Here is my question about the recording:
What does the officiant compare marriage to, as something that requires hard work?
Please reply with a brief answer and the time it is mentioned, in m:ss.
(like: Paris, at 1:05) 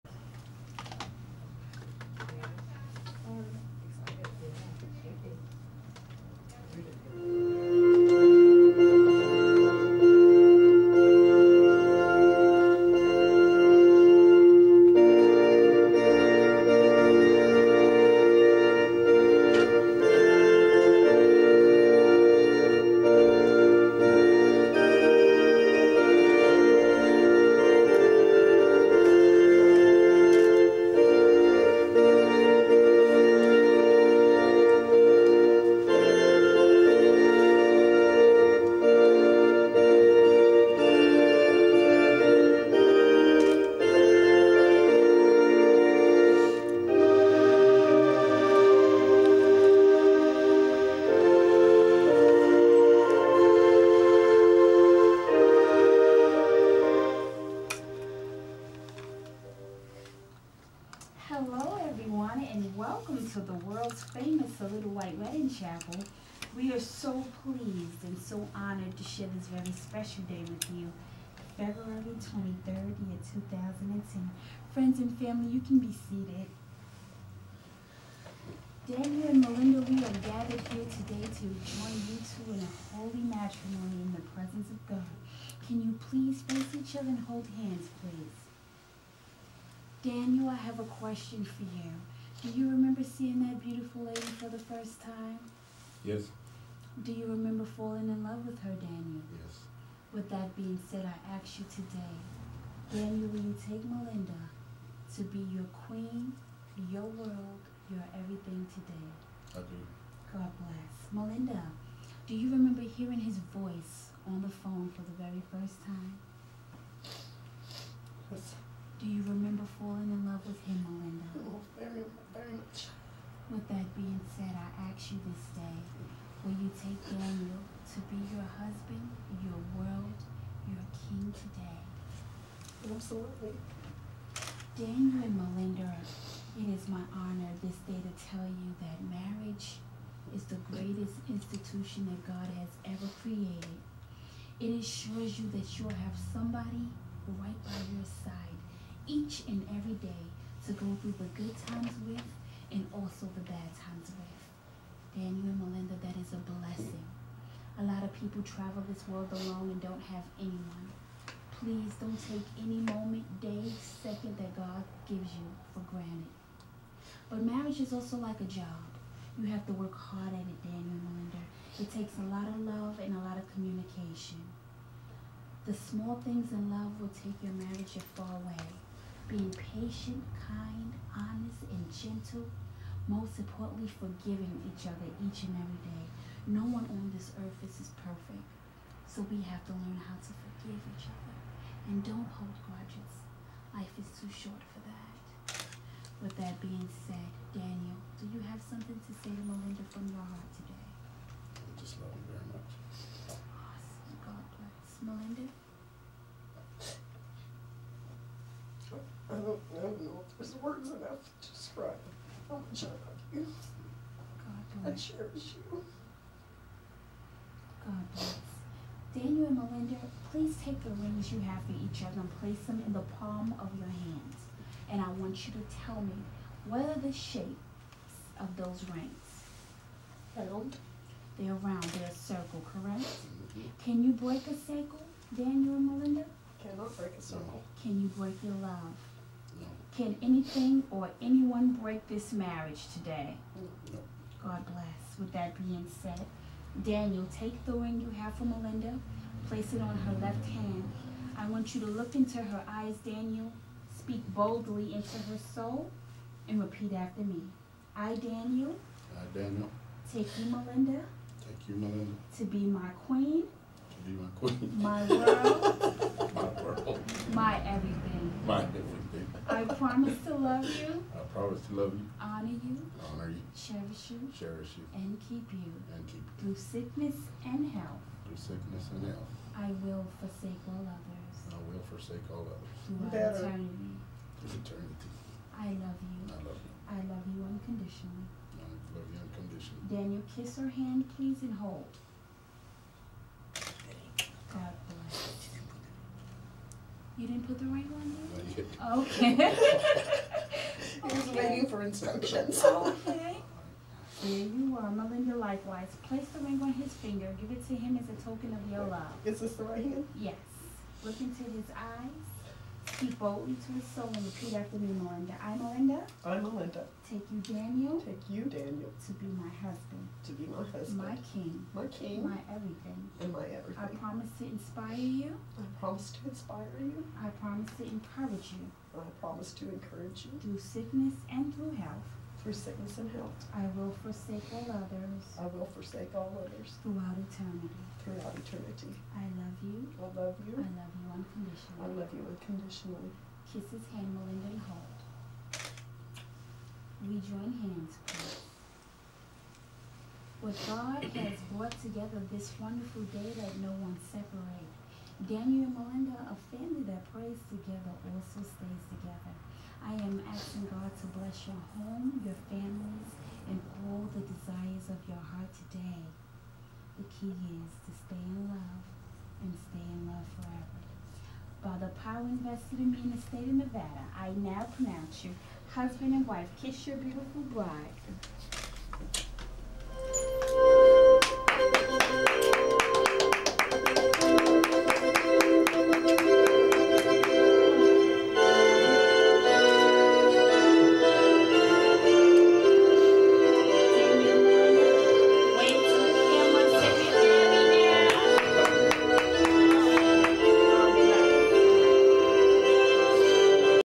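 A job, at 2:48.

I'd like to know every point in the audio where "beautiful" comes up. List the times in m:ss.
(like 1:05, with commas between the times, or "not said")
1:33, 6:16.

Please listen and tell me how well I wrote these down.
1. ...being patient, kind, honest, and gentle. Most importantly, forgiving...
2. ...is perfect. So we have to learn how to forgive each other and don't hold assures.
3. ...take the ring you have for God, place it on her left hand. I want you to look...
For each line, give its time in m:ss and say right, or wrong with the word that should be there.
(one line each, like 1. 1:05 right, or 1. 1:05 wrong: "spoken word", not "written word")
1. 2:59 right
2. 3:07 wrong: "grudges", not "assures"
3. 4:07 wrong: "Malinda", not "God".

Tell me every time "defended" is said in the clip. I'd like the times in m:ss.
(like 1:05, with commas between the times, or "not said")
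not said.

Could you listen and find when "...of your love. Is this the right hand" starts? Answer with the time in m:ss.
5:08.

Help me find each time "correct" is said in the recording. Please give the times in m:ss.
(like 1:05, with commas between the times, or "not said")
3:52.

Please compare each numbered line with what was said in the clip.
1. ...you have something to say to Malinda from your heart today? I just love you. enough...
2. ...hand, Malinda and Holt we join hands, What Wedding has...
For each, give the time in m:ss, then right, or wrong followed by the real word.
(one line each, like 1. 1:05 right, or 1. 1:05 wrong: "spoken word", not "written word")
1. 3:18 right
2. 5:43 wrong: "God", not "Wedding".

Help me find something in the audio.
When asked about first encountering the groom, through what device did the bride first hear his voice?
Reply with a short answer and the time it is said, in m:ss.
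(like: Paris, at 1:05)
The phone, at 1:54.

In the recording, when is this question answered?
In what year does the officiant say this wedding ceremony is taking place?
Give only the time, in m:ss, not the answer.
1:12.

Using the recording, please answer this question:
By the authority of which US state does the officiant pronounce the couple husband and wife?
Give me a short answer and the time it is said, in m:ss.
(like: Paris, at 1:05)
Nevada, at 6:13.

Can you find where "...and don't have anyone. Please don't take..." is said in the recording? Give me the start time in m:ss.
2:39.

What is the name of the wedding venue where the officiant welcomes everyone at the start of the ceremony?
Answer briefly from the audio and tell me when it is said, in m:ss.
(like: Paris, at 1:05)
The Little White Wedding Chapel, at 1:04.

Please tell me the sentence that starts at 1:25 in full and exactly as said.
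Can you please face each other and hold hands, please?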